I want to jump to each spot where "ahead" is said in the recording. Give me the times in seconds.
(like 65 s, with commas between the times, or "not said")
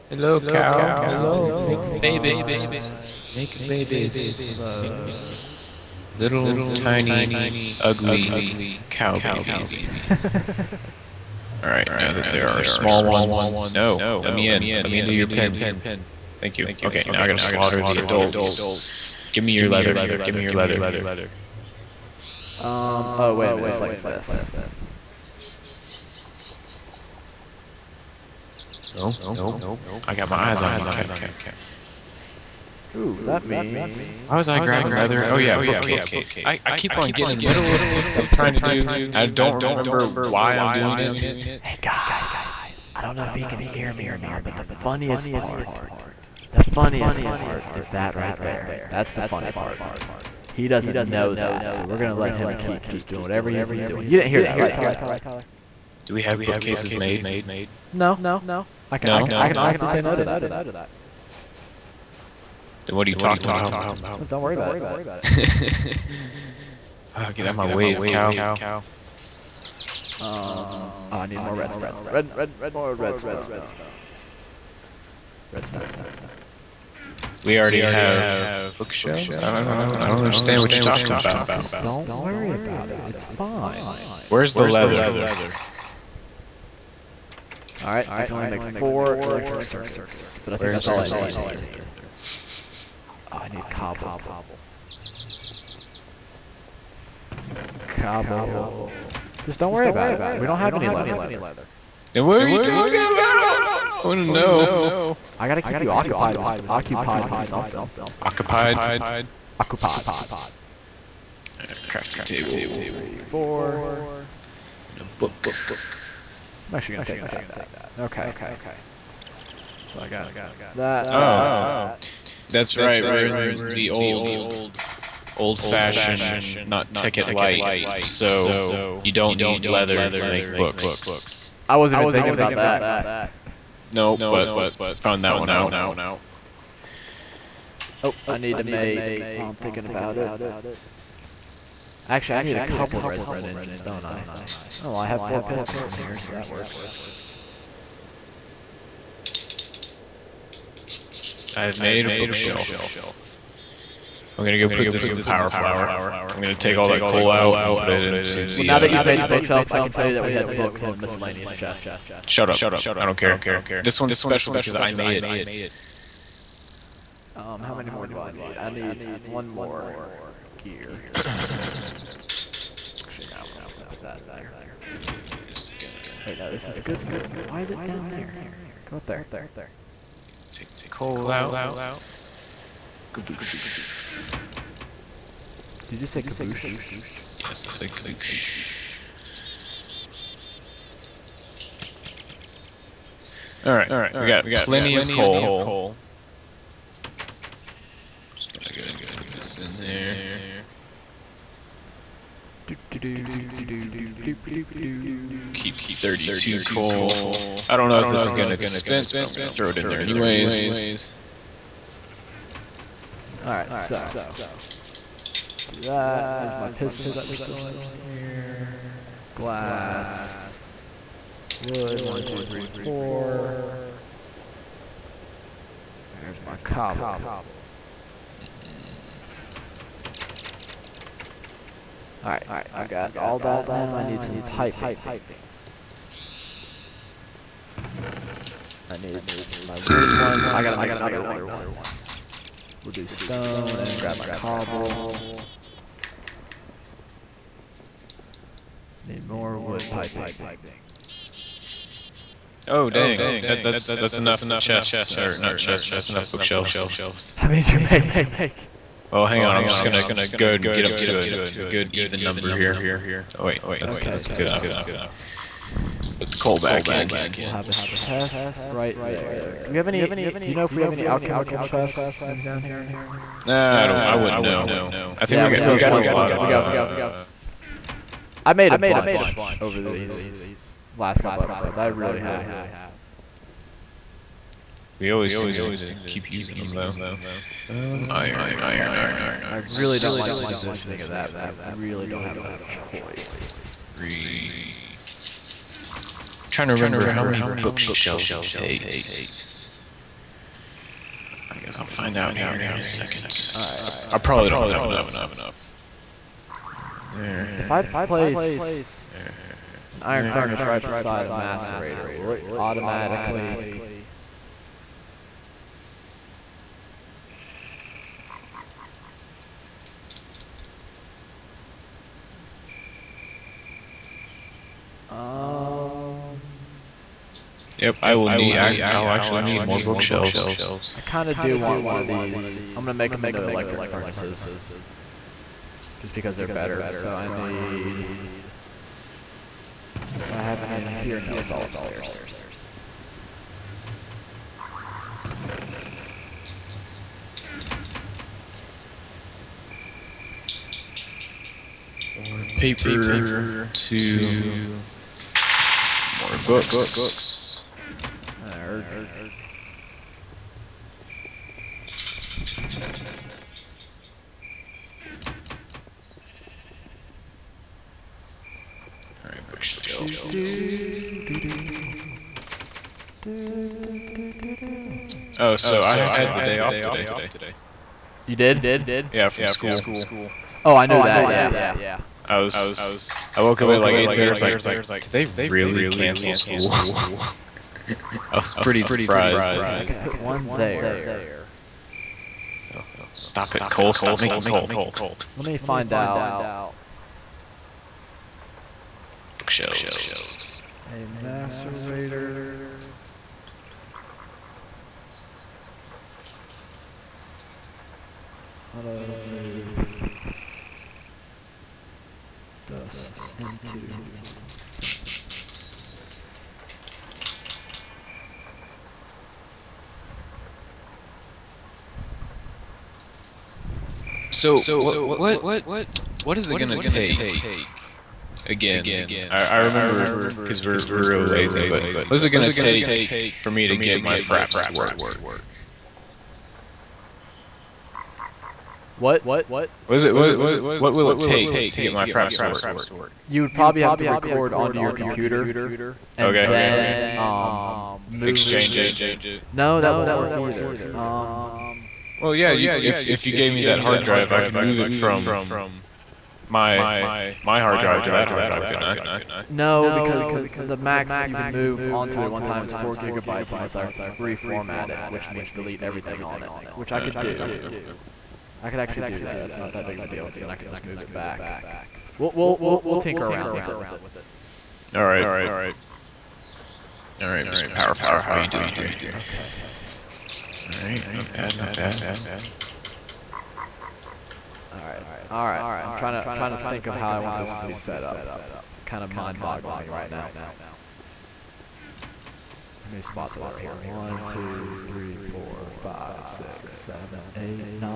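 260 s.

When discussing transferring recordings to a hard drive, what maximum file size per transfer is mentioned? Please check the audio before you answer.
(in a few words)
4 gigabytes.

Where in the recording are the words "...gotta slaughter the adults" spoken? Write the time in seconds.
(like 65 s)
17 s.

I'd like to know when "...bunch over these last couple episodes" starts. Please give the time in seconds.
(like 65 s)
278 s.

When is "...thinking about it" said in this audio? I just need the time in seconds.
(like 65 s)
139 s.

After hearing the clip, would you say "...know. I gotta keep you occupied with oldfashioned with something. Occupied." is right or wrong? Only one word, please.
wrong.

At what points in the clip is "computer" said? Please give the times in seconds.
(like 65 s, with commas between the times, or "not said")
444 s.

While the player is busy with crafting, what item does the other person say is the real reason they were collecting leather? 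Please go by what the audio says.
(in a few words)
bookcase.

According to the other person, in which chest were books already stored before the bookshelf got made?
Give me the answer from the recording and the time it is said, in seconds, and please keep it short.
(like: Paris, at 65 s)
miscellaneous chest, at 160 s.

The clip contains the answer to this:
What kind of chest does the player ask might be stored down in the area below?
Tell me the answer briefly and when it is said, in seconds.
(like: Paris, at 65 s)
alchemical chests, at 271 s.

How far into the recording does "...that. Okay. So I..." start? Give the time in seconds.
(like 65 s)
117 s.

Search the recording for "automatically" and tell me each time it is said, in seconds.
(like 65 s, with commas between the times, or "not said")
312 s.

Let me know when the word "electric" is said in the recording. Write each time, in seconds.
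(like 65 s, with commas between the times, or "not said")
89 s, 333 s.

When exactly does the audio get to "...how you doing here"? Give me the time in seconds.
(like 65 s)
478 s.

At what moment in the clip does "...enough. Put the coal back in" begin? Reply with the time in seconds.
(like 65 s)
264 s.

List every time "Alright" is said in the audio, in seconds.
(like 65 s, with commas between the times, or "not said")
11 s, 193 s, 213 s, 232 s, 303 s.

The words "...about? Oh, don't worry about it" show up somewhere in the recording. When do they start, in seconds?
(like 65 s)
63 s.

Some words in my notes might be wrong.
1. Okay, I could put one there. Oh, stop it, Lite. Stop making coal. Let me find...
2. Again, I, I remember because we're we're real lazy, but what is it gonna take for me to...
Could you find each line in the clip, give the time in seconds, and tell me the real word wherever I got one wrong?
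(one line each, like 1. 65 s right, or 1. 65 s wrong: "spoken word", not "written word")
1. 389 s wrong: "Cole", not "Lite"
2. 428 s right.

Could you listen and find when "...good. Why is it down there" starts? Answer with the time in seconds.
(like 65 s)
176 s.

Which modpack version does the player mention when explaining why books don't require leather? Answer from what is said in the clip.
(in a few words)
Tekkit Lite.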